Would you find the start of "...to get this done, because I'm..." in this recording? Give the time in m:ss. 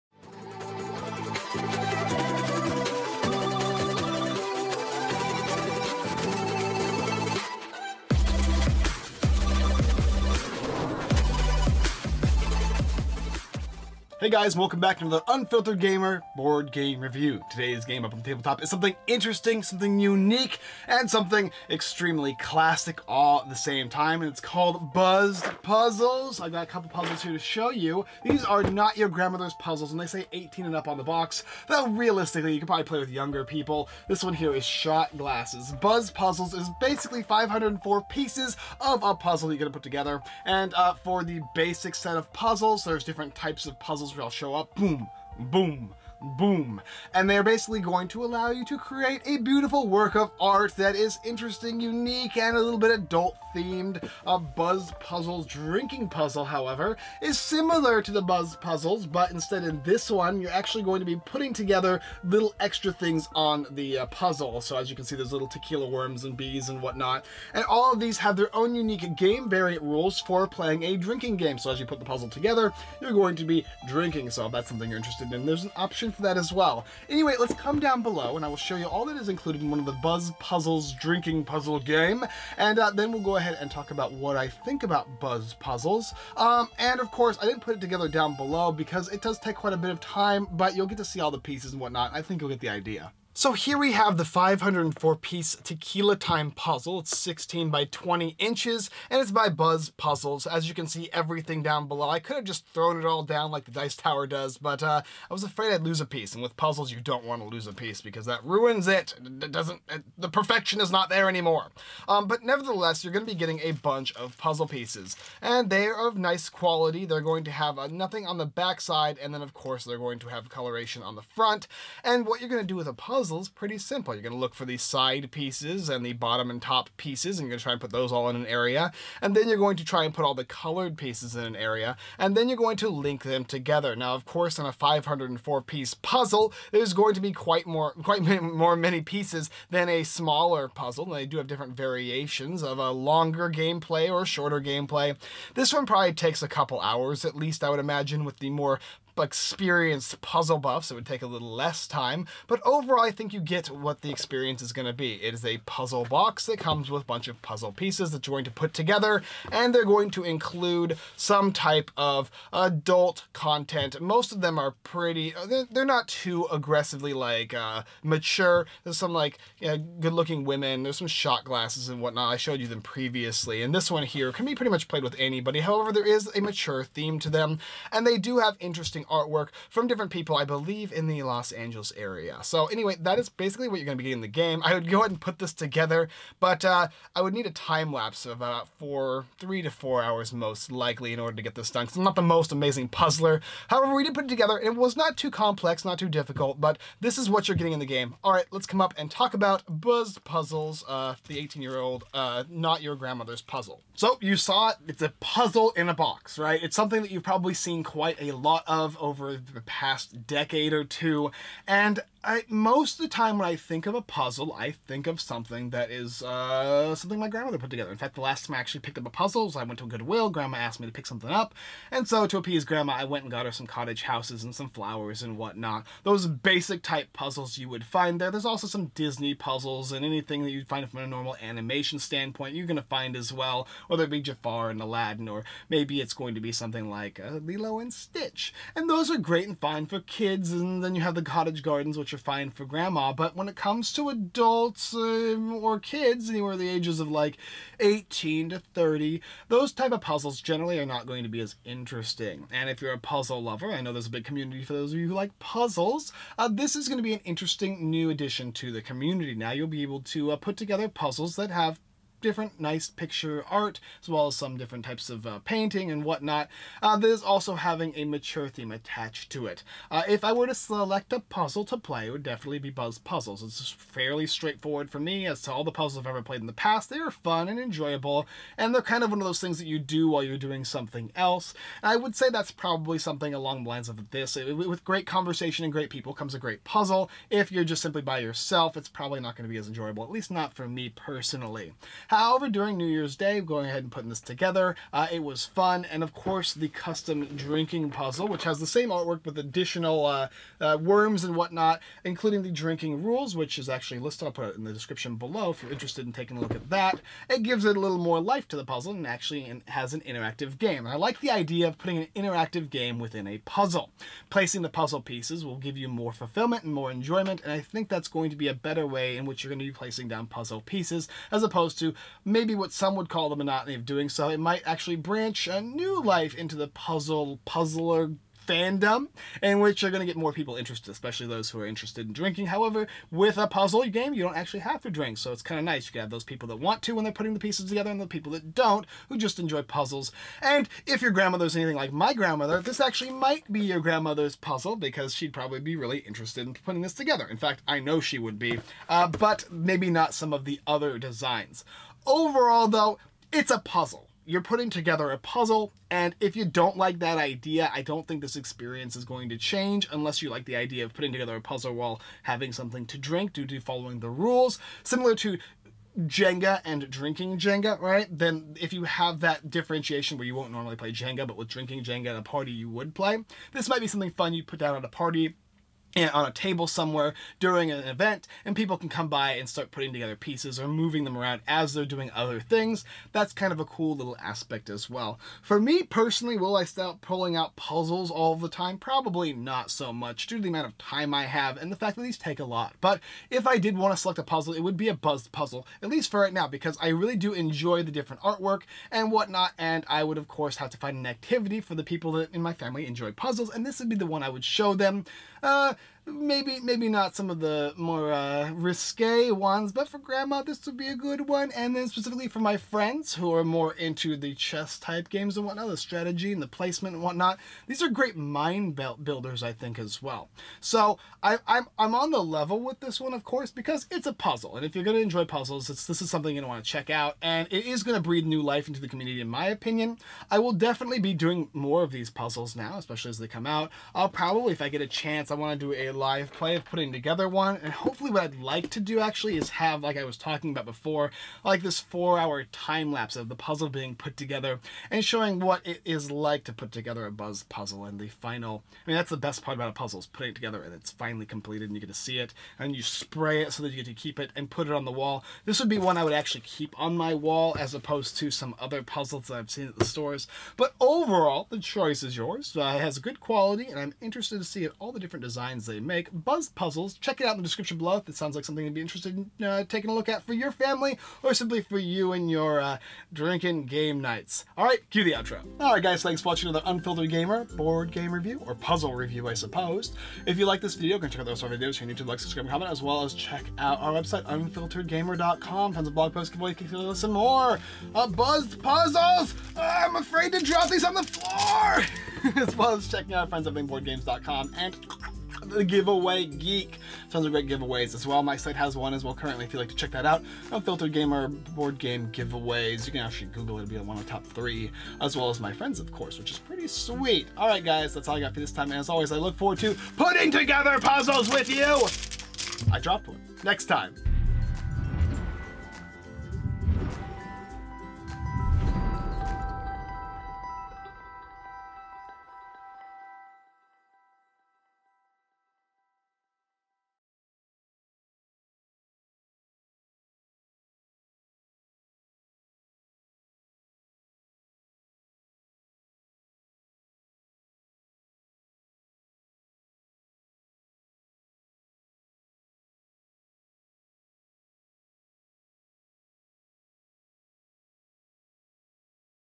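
3:11.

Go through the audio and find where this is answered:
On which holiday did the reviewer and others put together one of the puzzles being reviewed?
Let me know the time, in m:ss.
4:52.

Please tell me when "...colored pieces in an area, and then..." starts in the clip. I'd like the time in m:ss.
2:10.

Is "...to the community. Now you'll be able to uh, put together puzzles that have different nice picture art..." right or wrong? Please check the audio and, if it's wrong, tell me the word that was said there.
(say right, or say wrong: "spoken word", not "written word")
right.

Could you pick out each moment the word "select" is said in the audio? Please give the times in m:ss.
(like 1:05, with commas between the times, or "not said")
4:30, 6:33.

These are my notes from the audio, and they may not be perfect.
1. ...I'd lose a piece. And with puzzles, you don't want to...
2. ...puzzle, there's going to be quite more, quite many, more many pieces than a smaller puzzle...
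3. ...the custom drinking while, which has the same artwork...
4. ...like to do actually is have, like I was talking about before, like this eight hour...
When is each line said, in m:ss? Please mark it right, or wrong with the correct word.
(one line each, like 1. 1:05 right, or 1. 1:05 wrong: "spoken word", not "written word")
1. 1:45 right
2. 2:16 right
3. 4:56 wrong: "puzzle", not "while"
4. 7:18 wrong: "four", not "eight".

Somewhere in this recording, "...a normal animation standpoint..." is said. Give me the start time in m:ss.
3:50.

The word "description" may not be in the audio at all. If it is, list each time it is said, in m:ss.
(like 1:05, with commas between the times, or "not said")
5:04, 7:47.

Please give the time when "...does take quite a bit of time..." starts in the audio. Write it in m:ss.
1:29.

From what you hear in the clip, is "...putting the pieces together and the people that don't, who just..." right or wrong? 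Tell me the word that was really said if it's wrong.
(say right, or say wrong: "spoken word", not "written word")
right.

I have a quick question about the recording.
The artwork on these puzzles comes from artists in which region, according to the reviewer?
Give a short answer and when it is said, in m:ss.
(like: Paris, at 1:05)
Los Angeles, at 3:01.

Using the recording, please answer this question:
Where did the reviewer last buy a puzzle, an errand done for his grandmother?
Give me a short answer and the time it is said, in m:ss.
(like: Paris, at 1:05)
Goodwill, at 3:39.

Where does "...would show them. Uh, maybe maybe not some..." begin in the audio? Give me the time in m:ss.
6:44.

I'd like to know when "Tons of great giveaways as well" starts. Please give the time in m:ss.
8:17.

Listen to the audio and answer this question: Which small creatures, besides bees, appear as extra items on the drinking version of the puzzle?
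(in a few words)
tequila worms.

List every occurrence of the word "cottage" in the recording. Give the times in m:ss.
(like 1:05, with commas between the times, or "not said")
3:43, 4:01.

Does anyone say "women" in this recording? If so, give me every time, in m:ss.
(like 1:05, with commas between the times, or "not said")
2:50.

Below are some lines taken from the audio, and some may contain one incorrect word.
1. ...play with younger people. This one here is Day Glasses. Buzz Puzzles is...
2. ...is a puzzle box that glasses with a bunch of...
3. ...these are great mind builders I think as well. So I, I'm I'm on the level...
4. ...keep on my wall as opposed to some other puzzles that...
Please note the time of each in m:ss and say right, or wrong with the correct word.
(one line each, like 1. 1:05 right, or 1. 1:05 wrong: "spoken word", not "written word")
1. 0:32 wrong: "Shot", not "Day"
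2. 2:35 wrong: "comes", not "glasses"
3. 6:57 right
4. 7:36 right.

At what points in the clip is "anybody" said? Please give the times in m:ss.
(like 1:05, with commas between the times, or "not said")
2:55.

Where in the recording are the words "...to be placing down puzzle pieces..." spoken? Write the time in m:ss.
5:19.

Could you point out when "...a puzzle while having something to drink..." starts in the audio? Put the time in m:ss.
6:01.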